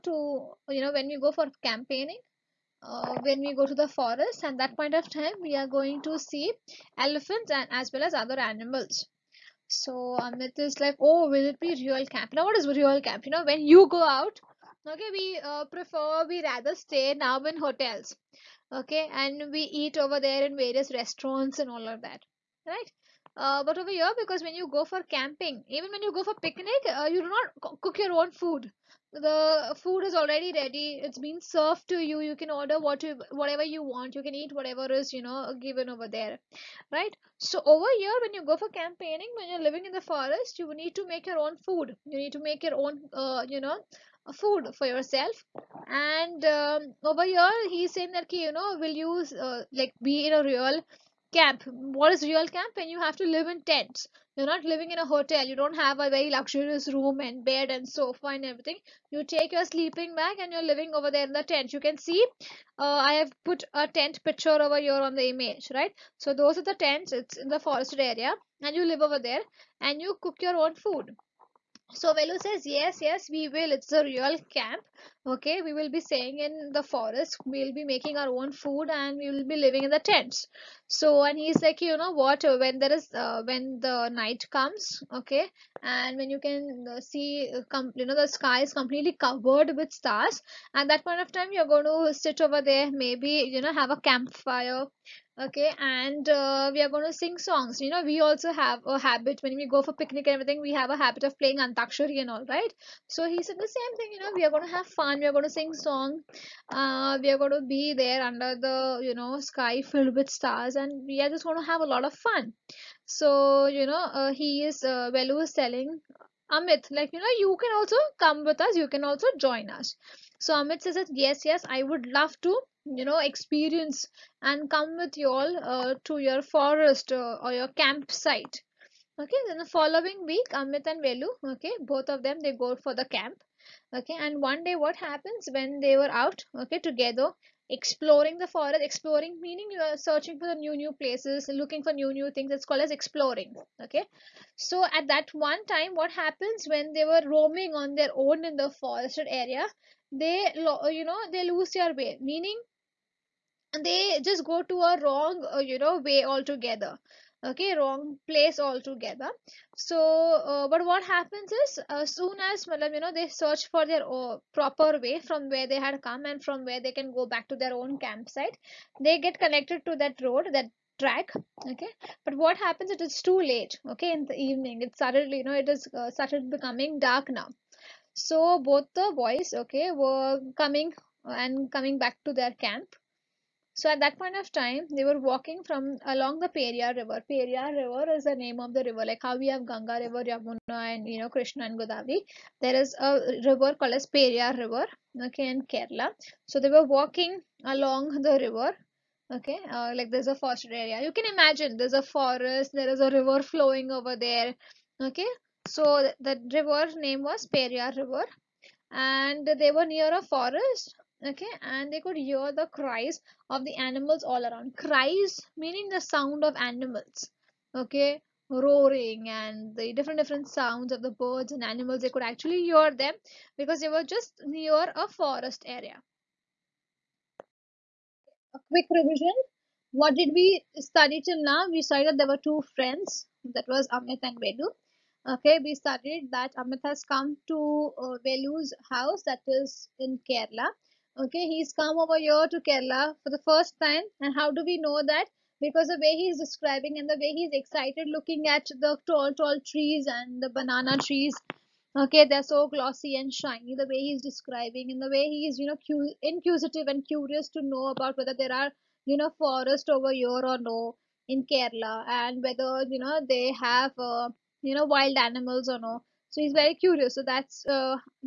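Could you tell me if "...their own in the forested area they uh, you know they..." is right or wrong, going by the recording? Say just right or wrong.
right.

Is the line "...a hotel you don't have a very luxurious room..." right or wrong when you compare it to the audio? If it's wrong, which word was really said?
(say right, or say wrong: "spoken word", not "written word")
right.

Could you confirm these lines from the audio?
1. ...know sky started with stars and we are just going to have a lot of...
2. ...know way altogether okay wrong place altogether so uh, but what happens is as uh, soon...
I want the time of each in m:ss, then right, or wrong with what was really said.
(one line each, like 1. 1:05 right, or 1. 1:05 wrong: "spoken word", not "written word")
1. 1:49 wrong: "filled", not "started"
2. 2:35 right.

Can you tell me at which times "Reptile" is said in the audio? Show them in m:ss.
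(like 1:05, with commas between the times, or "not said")
not said.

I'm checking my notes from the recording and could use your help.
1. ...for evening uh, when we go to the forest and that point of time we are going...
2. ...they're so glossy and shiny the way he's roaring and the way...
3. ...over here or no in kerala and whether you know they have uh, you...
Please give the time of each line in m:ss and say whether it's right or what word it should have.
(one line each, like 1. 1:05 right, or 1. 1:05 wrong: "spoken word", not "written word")
1. 0:01 wrong: "campaigning", not "evening"
2. 4:12 wrong: "describing", not "roaring"
3. 4:19 right.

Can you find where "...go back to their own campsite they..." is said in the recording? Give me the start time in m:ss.
2:47.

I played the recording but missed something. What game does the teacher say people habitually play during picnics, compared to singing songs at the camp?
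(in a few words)
Antakshari.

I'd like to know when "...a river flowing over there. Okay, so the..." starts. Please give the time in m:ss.
3:22.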